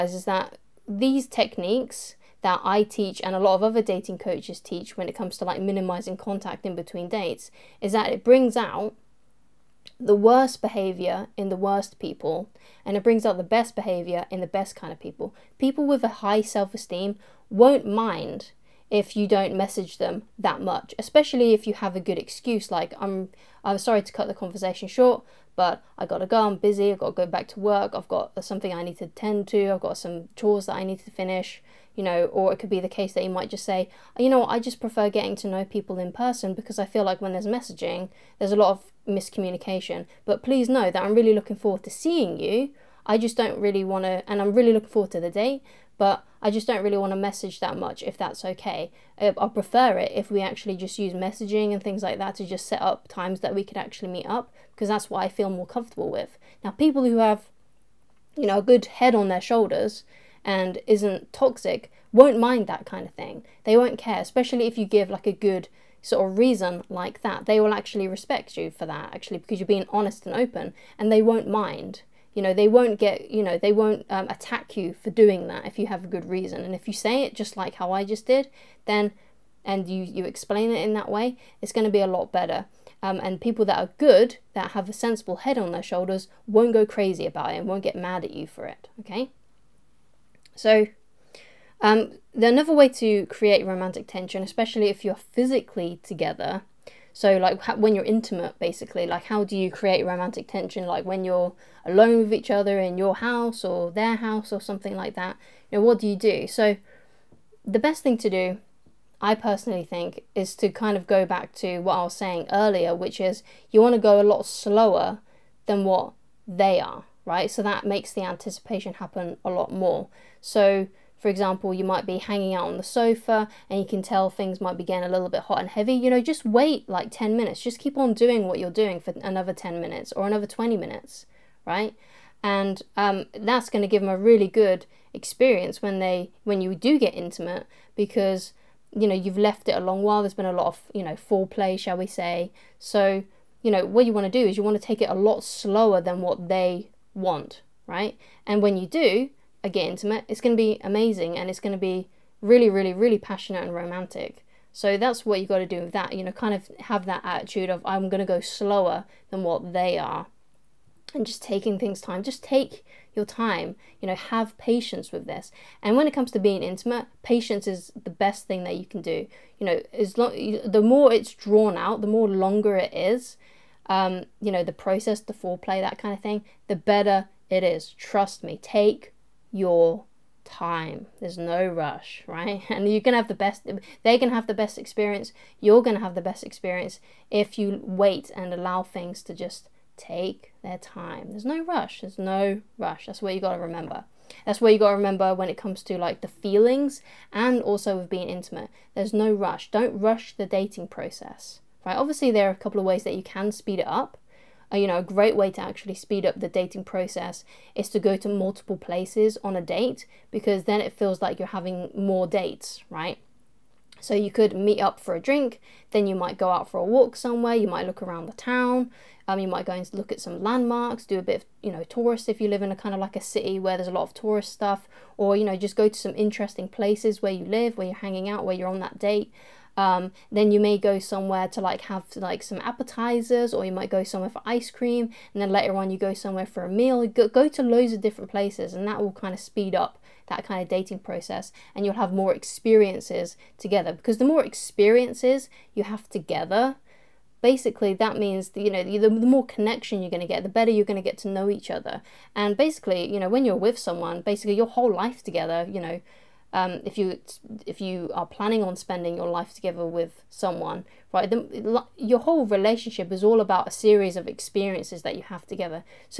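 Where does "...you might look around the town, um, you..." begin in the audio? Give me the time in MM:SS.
03:37.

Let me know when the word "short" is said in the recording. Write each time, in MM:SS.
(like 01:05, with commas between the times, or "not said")
00:24.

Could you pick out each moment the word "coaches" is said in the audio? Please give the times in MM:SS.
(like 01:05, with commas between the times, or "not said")
00:04.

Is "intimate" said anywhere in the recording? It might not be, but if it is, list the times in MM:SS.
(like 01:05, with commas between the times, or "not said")
01:38, 02:17, 02:29, 02:46, 03:18.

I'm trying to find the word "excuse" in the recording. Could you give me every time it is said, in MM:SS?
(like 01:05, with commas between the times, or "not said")
00:22.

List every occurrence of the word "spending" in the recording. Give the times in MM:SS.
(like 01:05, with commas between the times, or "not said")
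04:18.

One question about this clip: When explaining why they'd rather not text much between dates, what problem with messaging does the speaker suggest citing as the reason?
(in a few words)
miscommunication.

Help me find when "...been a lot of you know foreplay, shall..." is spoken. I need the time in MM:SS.
02:20.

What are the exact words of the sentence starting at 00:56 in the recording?
Now, people who have, you know, a good head on their shoulders and isn't toxic won't mind that kind of thing.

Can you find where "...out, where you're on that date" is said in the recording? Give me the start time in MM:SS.
03:48.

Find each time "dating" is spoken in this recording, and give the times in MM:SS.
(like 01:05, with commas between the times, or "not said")
00:03, 03:20, 03:26, 04:00.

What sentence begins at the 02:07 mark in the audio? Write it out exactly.
Just keep on doing what you're doing for another 10 minutes or another 20 minutes, right?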